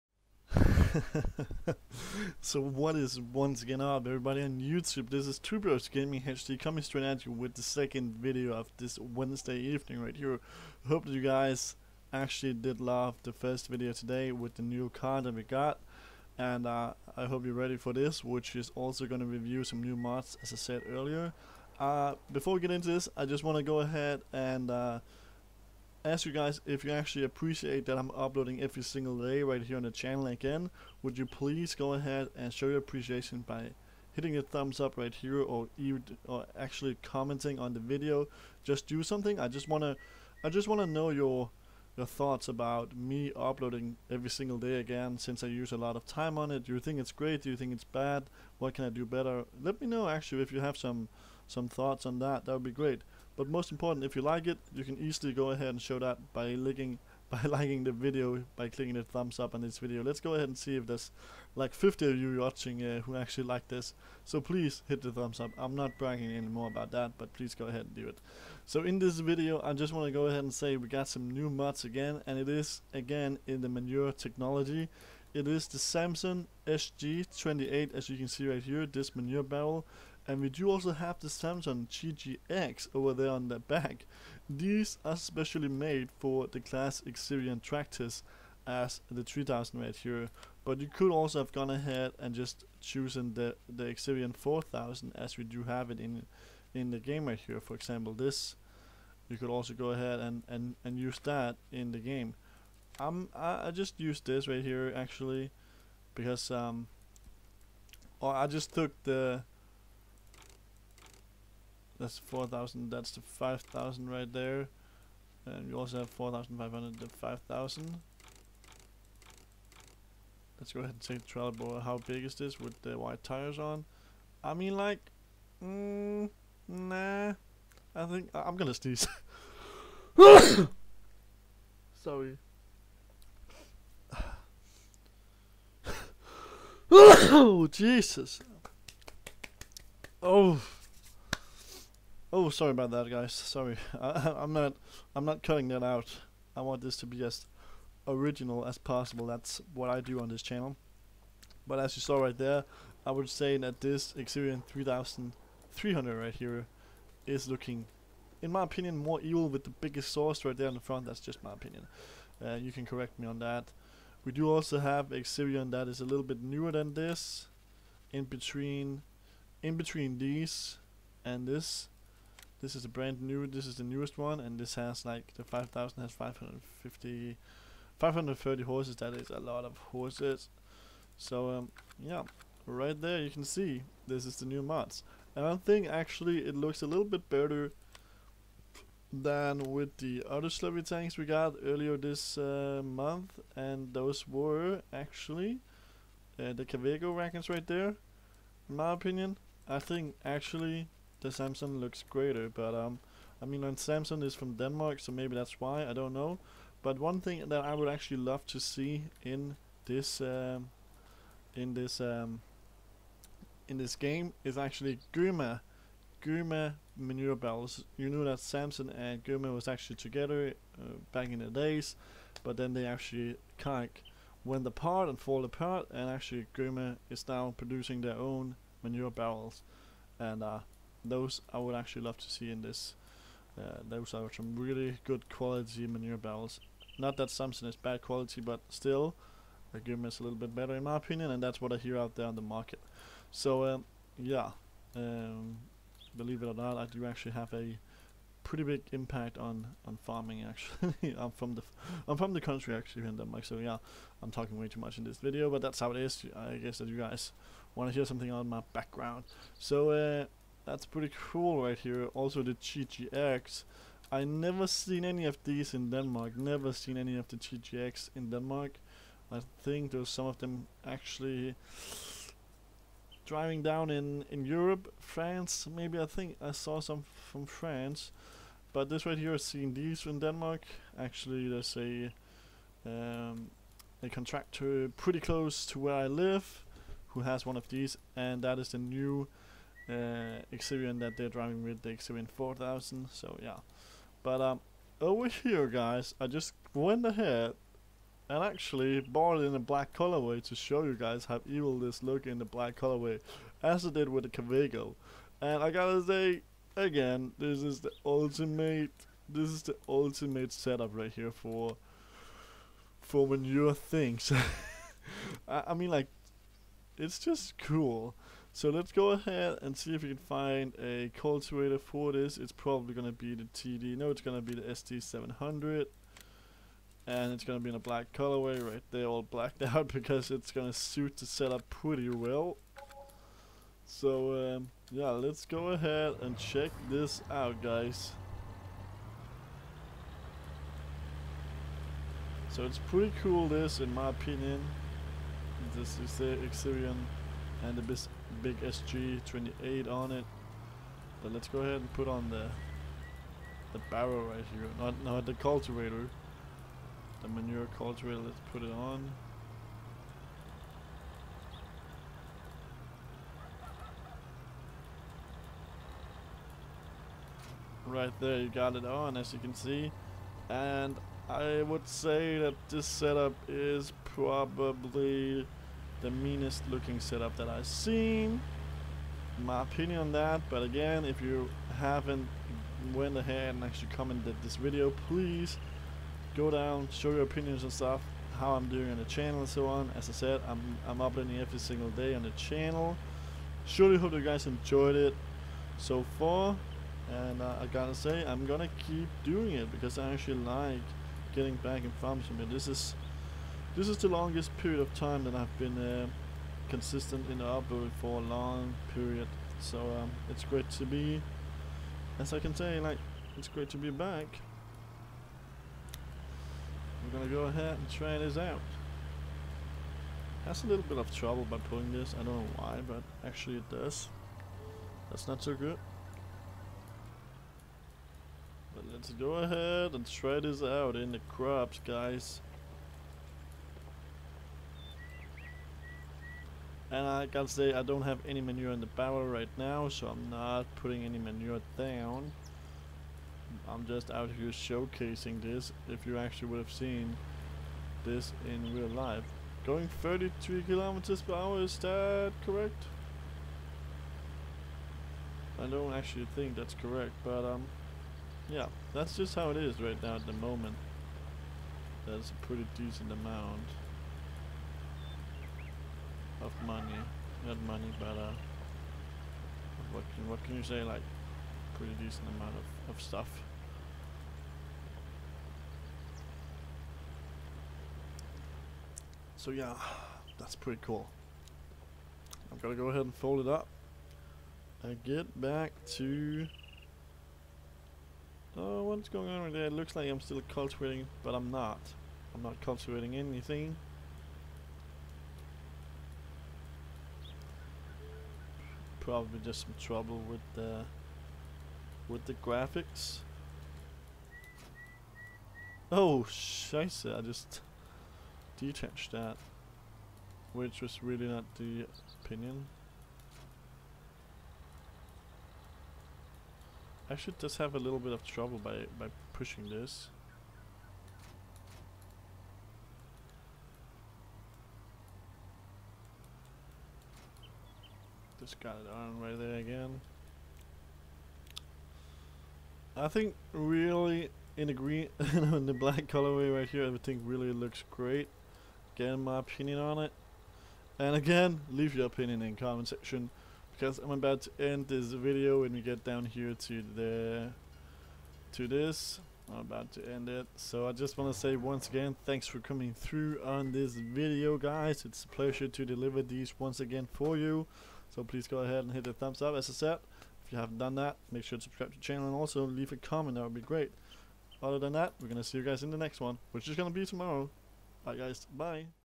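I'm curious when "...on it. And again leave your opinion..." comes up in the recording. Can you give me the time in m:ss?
8:59.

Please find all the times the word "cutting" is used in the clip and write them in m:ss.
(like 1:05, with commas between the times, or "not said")
2:25.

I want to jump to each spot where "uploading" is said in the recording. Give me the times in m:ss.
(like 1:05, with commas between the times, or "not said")
0:28, 0:43, 6:31.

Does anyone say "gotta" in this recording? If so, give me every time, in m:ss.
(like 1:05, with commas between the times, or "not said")
5:05, 6:37, 7:17.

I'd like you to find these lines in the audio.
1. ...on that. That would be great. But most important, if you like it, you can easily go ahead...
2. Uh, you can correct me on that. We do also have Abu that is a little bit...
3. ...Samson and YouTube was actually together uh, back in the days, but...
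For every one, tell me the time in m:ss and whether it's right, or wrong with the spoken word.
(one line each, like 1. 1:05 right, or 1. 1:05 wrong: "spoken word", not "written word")
1. 0:52 right
2. 2:42 wrong: "Xerion", not "Abu"
3. 3:38 wrong: "Guma", not "YouTube".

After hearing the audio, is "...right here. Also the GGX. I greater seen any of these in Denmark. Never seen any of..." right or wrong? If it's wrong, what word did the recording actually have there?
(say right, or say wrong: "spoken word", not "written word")
wrong: "never", not "greater".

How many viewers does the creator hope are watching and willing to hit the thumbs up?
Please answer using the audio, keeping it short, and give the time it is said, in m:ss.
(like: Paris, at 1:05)
50, at 1:01.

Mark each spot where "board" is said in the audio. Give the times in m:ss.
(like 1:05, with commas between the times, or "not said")
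2:01.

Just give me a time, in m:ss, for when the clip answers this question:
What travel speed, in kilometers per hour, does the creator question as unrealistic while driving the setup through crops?
7:30.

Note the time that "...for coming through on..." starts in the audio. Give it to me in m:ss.
9:12.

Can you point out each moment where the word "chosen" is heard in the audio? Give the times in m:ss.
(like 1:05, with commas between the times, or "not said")
1:32.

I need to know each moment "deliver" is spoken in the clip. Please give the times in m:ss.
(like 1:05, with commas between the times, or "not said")
9:15.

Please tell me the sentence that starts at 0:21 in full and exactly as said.
Uh, before we get into this, I just want to go ahead and...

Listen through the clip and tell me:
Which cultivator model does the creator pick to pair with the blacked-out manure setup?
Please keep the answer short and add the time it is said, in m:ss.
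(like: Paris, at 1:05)
ST700, at 5:24.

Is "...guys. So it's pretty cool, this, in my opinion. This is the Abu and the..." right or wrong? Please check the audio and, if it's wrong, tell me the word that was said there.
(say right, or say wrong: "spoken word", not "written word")
wrong: "Xerion", not "Abu".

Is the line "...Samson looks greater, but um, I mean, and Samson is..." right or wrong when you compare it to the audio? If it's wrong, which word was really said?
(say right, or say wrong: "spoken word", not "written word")
right.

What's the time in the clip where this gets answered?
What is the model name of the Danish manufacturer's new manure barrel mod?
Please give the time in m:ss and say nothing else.
1:15.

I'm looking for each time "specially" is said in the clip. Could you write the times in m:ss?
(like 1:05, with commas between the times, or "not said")
1:25.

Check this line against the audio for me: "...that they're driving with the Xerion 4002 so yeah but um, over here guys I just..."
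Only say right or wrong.
wrong.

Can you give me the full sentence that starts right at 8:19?
probably just some trouble with the with the graphics.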